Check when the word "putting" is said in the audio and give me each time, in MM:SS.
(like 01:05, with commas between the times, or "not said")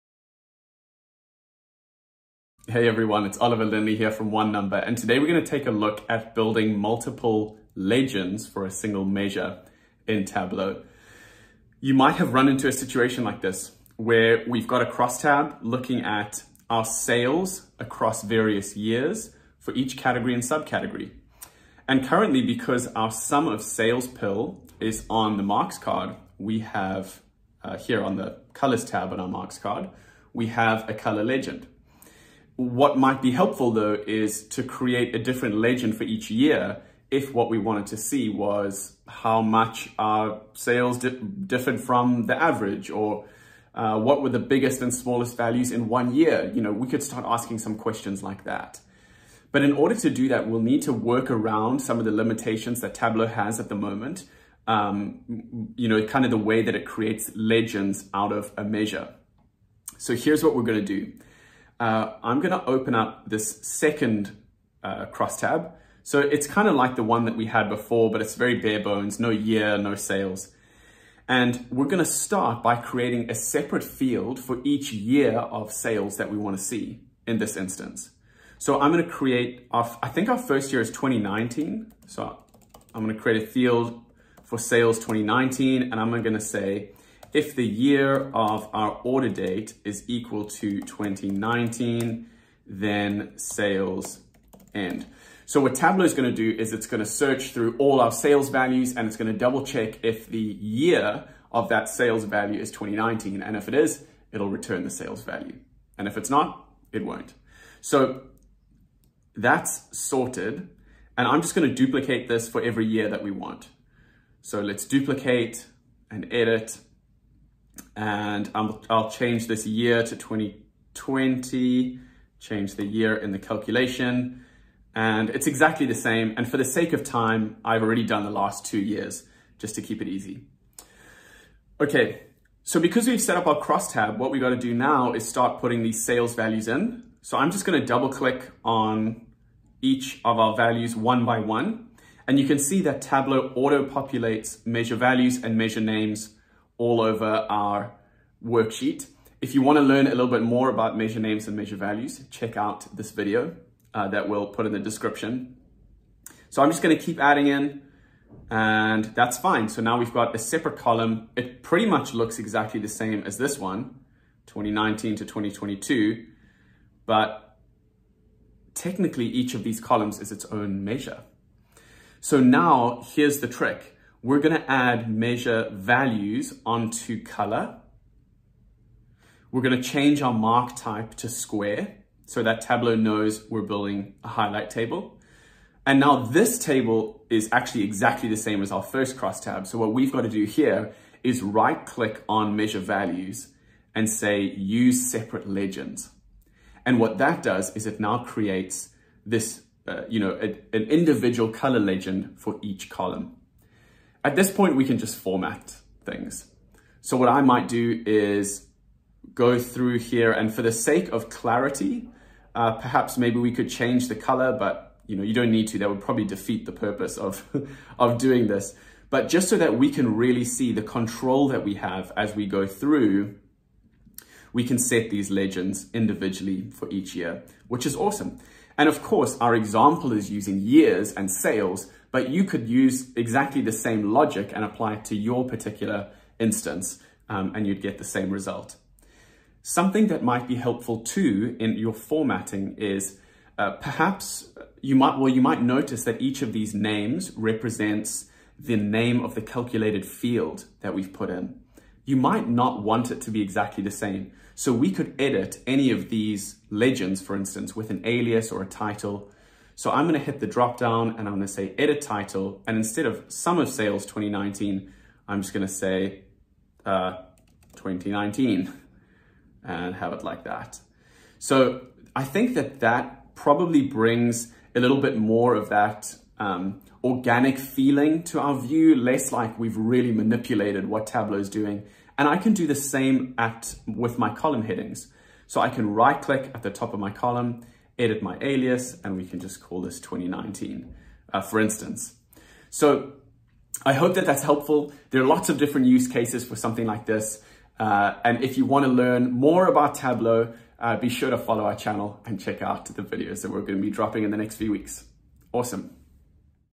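02:15.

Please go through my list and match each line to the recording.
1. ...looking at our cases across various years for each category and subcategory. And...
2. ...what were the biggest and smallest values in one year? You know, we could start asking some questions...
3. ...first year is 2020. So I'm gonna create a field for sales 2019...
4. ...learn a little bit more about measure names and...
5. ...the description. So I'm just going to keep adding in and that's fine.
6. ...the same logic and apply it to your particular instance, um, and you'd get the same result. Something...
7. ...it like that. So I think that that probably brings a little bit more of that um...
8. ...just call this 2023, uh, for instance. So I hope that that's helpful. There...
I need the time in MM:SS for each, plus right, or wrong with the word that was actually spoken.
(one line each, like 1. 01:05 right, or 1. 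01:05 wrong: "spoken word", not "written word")
1. 00:15 wrong: "sales", not "cases"
2. 00:43 right
3. 01:20 wrong: "2019", not "2020"
4. 02:29 right
5. 02:34 right
6. 03:53 right
7. 04:30 right
8. 04:49 wrong: "2019", not "2023".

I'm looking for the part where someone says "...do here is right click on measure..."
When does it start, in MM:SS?
03:10.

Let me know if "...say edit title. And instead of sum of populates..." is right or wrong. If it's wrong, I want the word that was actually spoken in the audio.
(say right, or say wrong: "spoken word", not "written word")
wrong: "sales", not "populates".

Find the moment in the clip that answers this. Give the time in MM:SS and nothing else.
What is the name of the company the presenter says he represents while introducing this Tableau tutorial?
00:04.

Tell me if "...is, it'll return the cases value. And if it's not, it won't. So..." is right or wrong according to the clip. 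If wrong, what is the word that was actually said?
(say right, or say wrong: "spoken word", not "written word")
wrong: "sales", not "cases".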